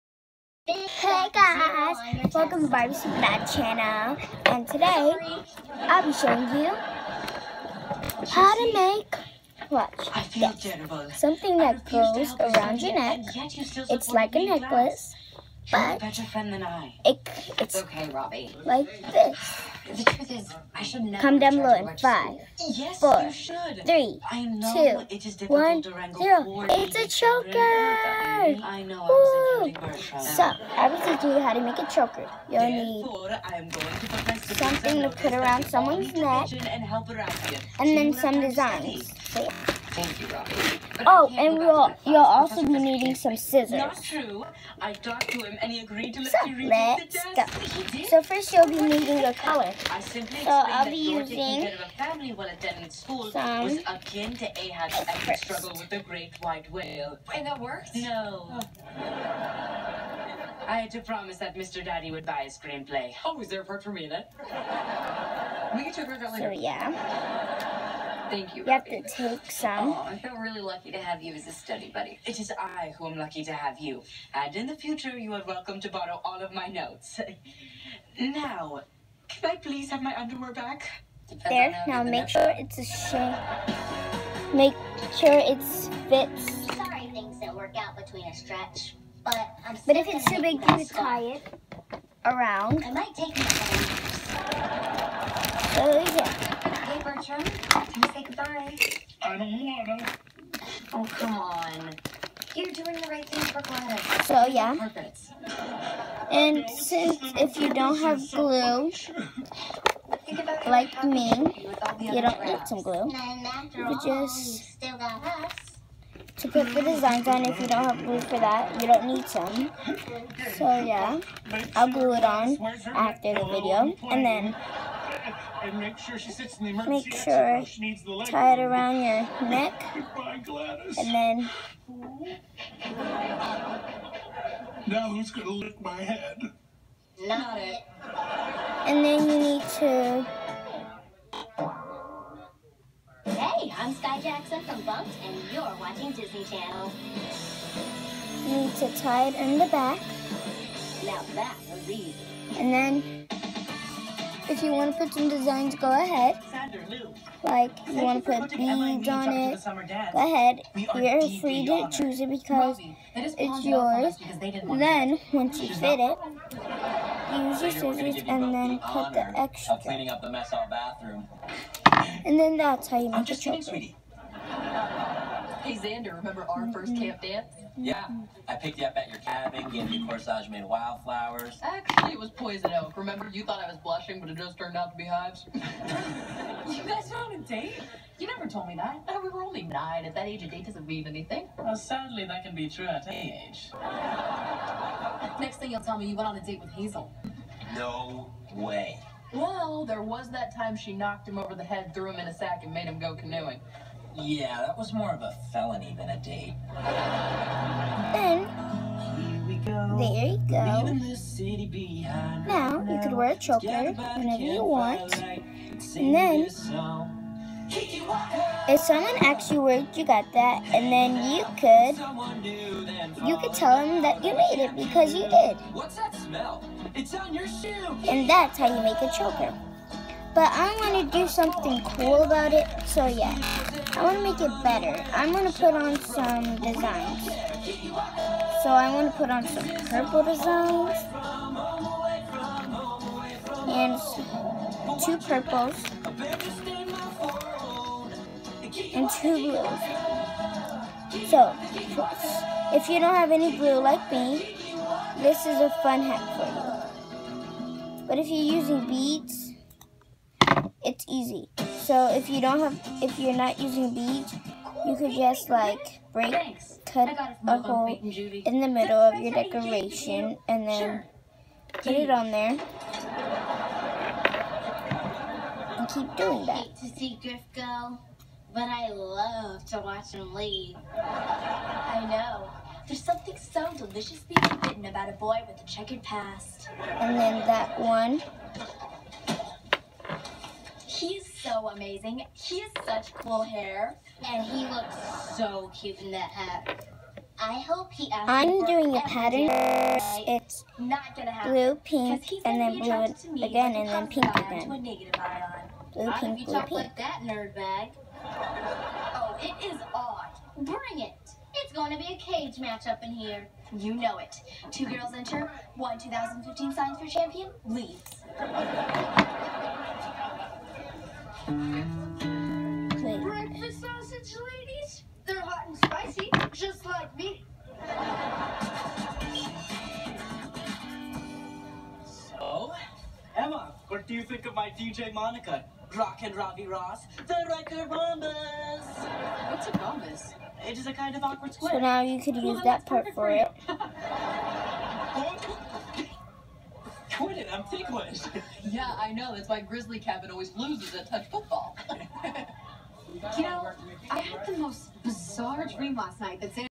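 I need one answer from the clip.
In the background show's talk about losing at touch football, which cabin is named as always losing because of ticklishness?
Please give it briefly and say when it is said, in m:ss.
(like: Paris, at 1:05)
Grizzly Cabin, at 5:49.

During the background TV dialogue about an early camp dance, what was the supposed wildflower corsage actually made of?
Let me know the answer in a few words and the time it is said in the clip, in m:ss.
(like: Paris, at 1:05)
poison oak, at 3:02.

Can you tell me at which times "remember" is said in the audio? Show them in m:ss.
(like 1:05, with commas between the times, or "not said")
2:56, 3:02.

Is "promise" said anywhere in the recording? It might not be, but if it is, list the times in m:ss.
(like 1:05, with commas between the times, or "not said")
1:01.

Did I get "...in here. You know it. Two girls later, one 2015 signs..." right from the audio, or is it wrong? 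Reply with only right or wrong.
wrong.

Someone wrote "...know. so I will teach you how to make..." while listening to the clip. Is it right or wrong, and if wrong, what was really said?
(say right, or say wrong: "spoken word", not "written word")
right.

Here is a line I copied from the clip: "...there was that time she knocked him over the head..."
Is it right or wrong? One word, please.
right.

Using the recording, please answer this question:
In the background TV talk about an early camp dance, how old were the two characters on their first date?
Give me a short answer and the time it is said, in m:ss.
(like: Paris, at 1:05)
9, at 3:09.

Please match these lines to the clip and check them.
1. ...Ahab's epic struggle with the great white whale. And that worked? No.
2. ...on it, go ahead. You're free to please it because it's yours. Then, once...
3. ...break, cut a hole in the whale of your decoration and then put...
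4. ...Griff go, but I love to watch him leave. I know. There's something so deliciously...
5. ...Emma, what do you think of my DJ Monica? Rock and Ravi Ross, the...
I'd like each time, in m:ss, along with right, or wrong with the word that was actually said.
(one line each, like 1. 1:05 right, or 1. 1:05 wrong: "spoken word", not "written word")
1. 0:54 right
2. 2:39 wrong: "choose", not "please"
3. 4:26 wrong: "middle", not "whale"
4. 4:37 right
5. 5:33 right.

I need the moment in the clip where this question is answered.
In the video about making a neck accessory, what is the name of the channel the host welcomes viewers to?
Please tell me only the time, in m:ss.
0:02.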